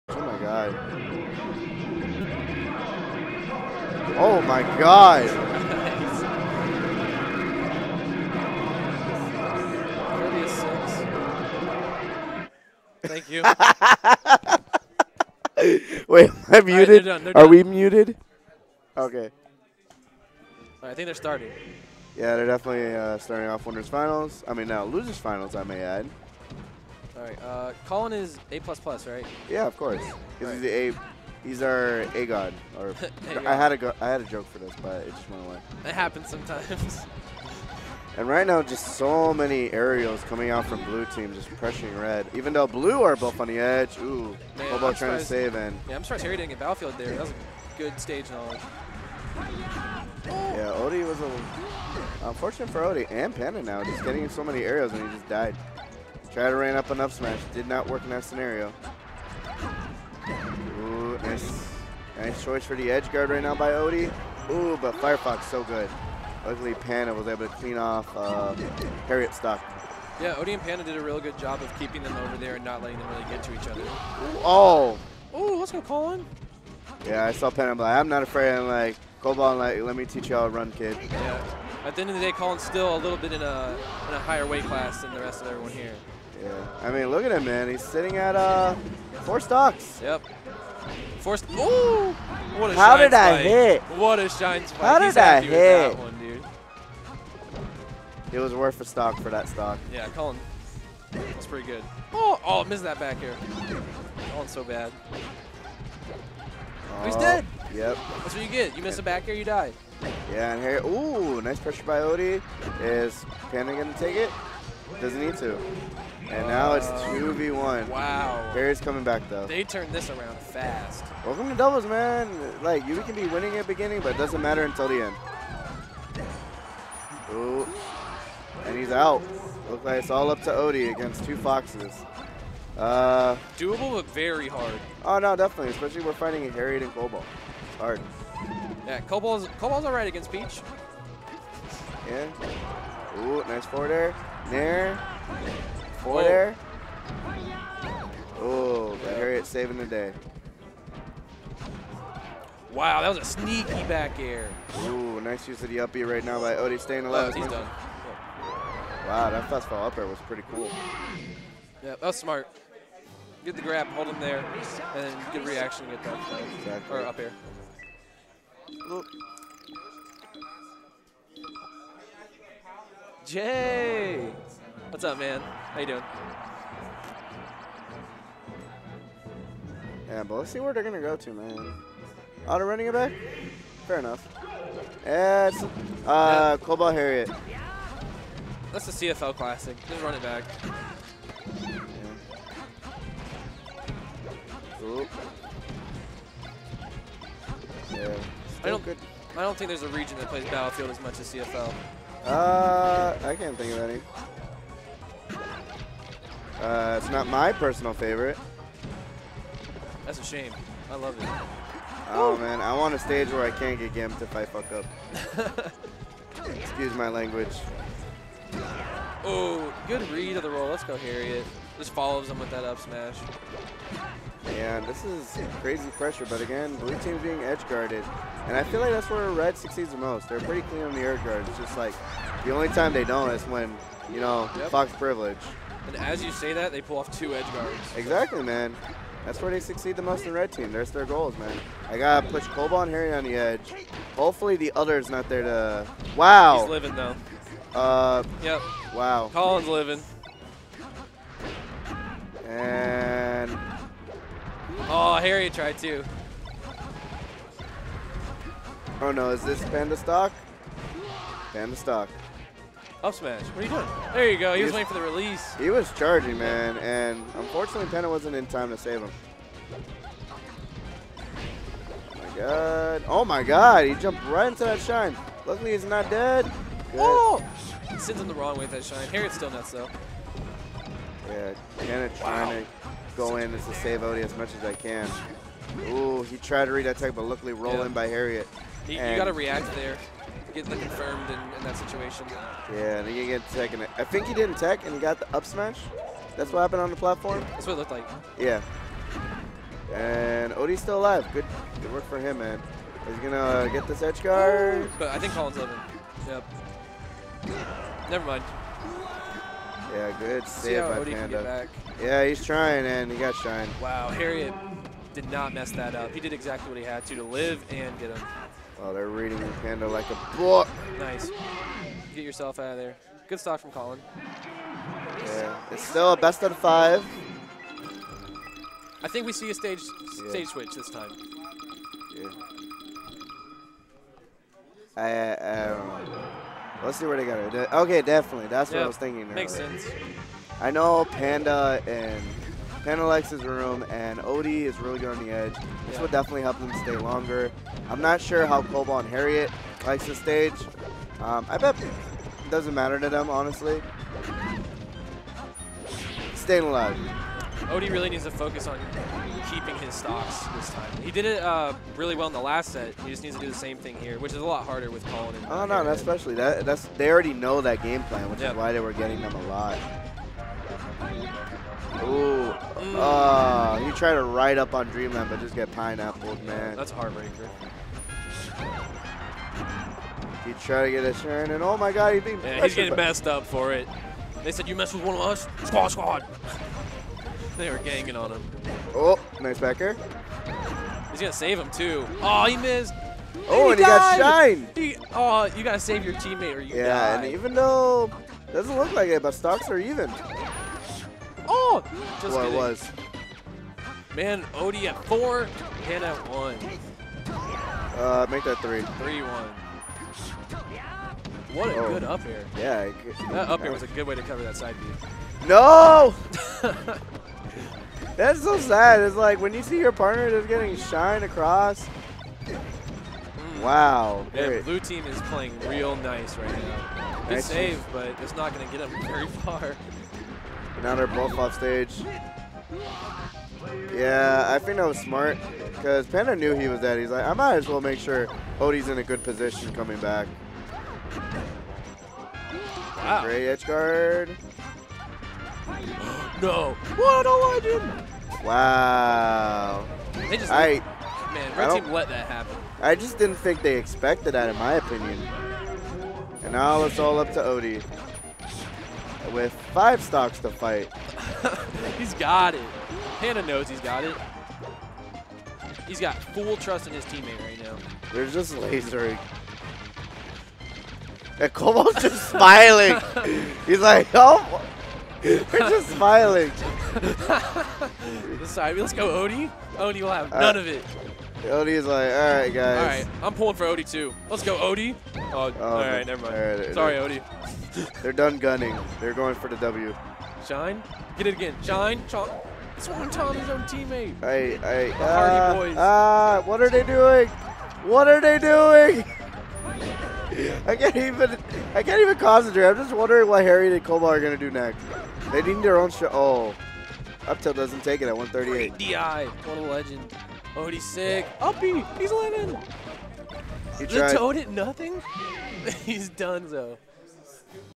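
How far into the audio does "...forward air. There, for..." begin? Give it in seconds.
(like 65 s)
143 s.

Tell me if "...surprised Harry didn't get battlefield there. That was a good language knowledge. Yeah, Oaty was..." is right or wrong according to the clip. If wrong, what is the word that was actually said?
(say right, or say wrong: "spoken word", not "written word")
wrong: "stage", not "language".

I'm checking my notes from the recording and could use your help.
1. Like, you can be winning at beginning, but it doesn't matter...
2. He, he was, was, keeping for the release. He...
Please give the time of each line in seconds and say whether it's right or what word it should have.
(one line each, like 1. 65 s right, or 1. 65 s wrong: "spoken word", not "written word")
1. 122 s right
2. 264 s wrong: "waiting", not "keeping".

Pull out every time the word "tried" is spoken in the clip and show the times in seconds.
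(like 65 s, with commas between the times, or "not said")
255 s, 286 s.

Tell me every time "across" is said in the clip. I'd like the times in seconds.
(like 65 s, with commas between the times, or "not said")
421 s.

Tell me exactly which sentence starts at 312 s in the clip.
Yeah, he's trying, and he got shined.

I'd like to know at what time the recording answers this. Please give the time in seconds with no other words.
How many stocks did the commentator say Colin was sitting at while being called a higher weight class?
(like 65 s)
89 s.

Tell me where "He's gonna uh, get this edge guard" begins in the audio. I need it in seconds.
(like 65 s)
303 s.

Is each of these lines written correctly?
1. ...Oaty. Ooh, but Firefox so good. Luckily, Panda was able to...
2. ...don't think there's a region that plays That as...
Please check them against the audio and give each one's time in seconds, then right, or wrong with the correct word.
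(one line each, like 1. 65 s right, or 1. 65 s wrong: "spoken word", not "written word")
1. 63 s right
2. 199 s wrong: "Battlefield", not "That".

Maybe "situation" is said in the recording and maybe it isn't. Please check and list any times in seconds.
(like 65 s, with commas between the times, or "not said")
291 s.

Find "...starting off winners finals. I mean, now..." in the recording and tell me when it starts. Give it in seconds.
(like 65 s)
23 s.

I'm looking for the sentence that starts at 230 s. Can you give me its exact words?
They're pretty clean on the edge guard.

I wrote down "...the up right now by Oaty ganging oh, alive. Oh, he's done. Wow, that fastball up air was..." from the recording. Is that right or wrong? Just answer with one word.
wrong.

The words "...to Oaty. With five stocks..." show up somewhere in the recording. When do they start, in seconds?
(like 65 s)
457 s.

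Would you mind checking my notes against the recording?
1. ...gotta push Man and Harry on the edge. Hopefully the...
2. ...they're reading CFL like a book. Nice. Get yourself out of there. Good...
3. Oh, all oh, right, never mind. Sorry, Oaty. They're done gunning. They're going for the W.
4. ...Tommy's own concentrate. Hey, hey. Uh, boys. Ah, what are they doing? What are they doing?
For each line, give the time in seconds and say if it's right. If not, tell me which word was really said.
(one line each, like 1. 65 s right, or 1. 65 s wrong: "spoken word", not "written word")
1. 241 s wrong: "Colbol", not "Man"
2. 318 s wrong: "Panda", not "CFL"
3. 485 s right
4. 493 s wrong: "teammate", not "concentrate".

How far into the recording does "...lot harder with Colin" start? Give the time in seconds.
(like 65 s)
364 s.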